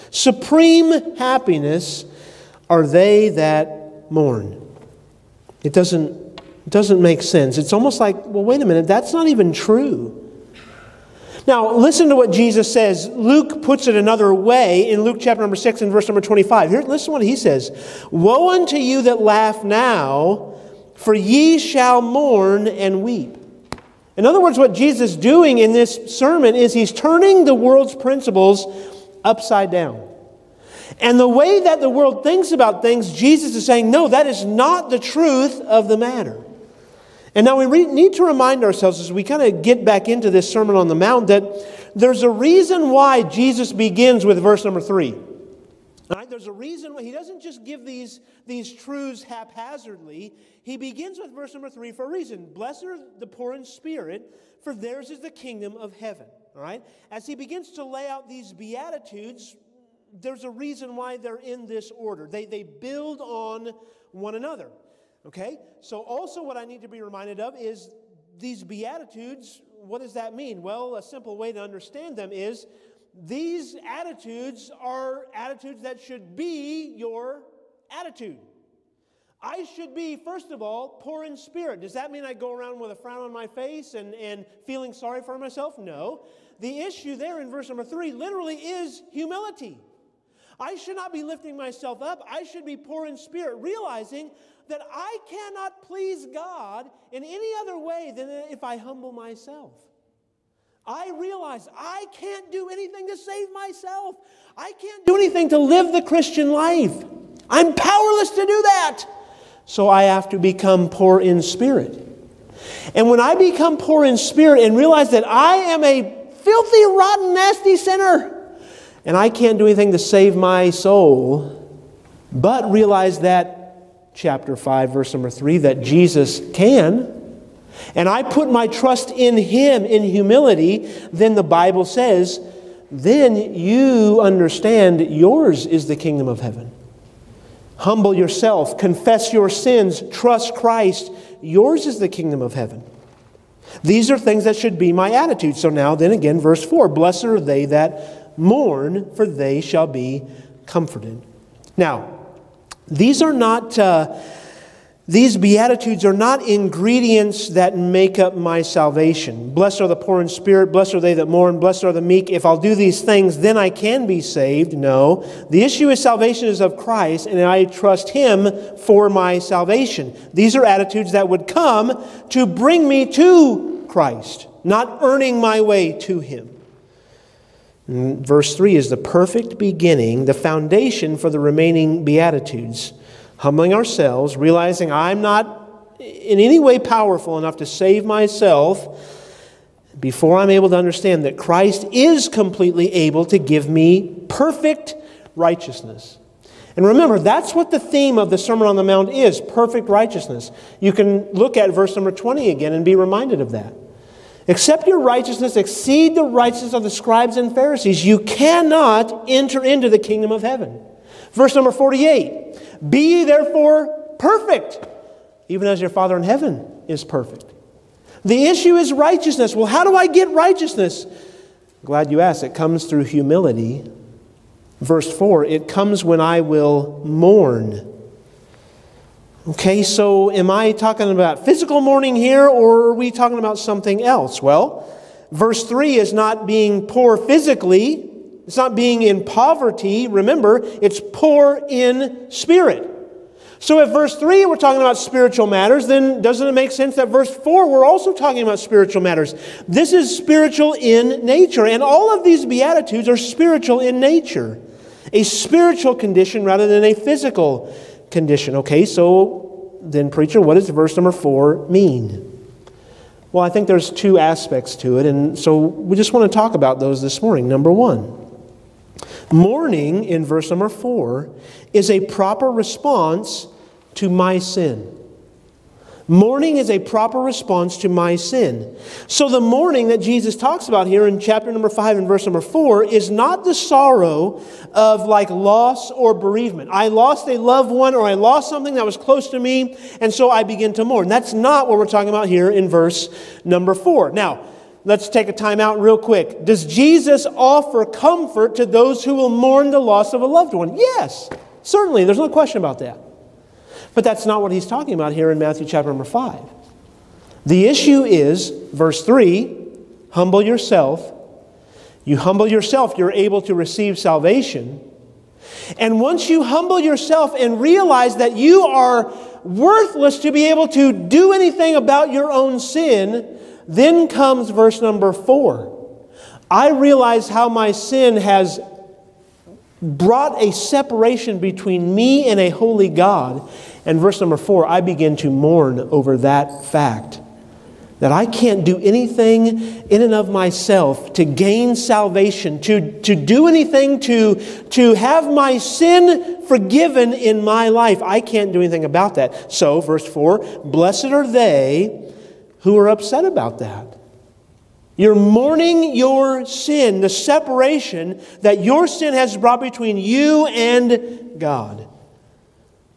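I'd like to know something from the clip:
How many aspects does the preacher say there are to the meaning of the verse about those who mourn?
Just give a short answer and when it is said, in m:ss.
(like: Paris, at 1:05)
2, at 4:23.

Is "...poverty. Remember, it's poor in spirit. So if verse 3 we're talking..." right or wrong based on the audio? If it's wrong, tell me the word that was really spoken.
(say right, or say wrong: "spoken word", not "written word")
right.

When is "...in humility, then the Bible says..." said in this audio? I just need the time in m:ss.
2:09.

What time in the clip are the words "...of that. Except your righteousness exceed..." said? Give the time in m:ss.
3:23.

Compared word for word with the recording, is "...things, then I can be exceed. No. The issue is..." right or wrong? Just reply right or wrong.
wrong.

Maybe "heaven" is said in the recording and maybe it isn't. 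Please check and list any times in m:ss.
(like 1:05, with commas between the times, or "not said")
0:55, 2:16, 2:22, 3:30, 3:36.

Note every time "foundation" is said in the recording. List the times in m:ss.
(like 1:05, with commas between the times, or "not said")
3:00.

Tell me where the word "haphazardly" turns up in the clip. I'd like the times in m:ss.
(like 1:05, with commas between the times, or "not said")
0:49.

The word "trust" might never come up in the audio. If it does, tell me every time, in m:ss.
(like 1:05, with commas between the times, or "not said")
2:08, 2:20, 2:47.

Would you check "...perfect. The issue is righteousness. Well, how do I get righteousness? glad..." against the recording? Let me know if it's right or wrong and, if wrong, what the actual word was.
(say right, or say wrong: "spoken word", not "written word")
right.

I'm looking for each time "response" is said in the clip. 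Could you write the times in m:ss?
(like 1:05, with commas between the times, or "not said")
4:32, 4:37.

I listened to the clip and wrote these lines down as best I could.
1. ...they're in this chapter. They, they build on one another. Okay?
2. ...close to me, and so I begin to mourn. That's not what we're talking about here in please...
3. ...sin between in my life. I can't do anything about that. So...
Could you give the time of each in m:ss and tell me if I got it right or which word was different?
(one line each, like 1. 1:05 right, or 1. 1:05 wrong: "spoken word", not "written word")
1. 1:01 wrong: "order", not "chapter"
2. 4:48 wrong: "verse", not "please"
3. 5:45 wrong: "forgiven", not "between".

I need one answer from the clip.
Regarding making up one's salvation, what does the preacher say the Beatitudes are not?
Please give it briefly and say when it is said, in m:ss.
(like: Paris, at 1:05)
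Ingredients, at 2:36.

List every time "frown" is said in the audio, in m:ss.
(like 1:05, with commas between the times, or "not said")
1:22.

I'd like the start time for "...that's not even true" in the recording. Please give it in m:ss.
0:08.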